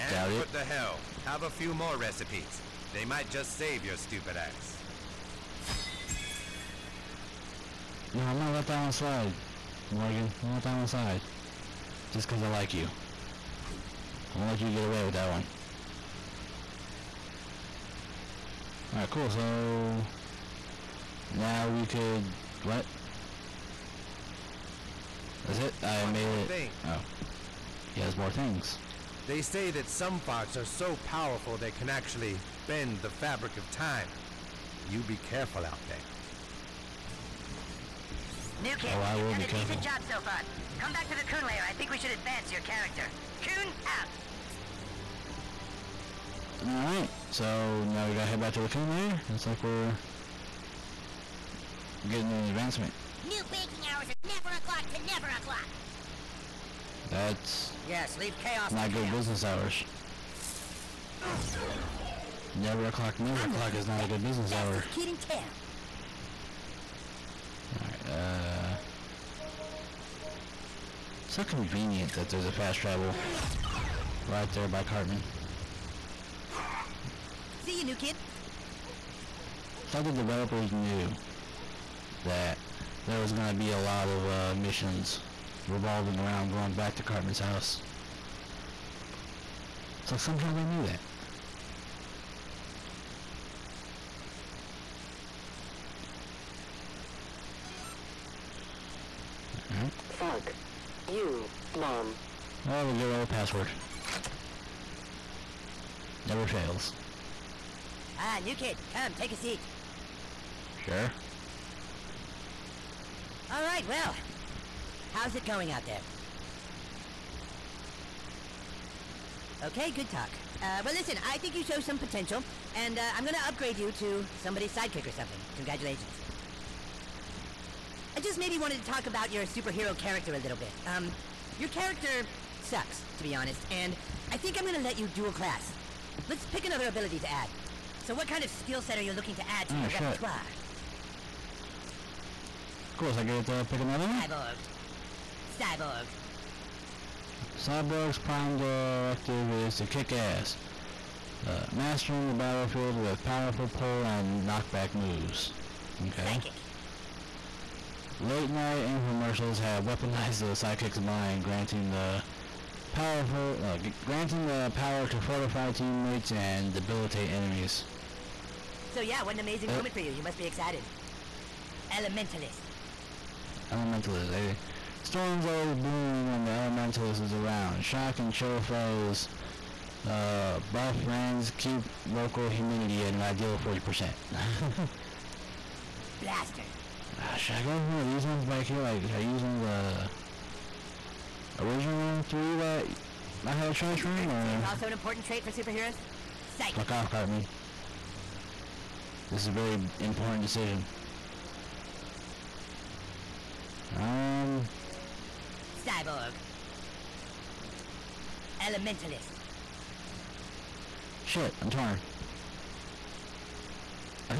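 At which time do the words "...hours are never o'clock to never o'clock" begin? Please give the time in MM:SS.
00:53.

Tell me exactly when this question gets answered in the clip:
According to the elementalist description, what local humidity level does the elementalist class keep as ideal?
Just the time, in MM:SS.
03:03.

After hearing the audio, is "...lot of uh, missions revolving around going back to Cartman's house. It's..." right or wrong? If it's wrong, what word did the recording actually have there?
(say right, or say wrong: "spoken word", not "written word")
right.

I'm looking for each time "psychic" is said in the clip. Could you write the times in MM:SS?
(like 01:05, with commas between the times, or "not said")
02:36, 02:40.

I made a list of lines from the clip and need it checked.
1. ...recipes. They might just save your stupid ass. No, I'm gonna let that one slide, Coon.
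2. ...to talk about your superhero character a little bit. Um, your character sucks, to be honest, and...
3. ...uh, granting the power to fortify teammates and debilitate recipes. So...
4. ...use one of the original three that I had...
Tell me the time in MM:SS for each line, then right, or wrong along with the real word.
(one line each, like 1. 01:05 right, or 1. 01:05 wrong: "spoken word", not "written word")
1. 00:01 wrong: "Morgan", not "Coon"
2. 02:08 right
3. 02:43 wrong: "enemies", not "recipes"
4. 03:09 right.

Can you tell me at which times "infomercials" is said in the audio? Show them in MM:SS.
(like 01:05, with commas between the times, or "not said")
02:38.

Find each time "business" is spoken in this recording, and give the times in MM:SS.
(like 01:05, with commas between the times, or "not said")
00:59, 01:04.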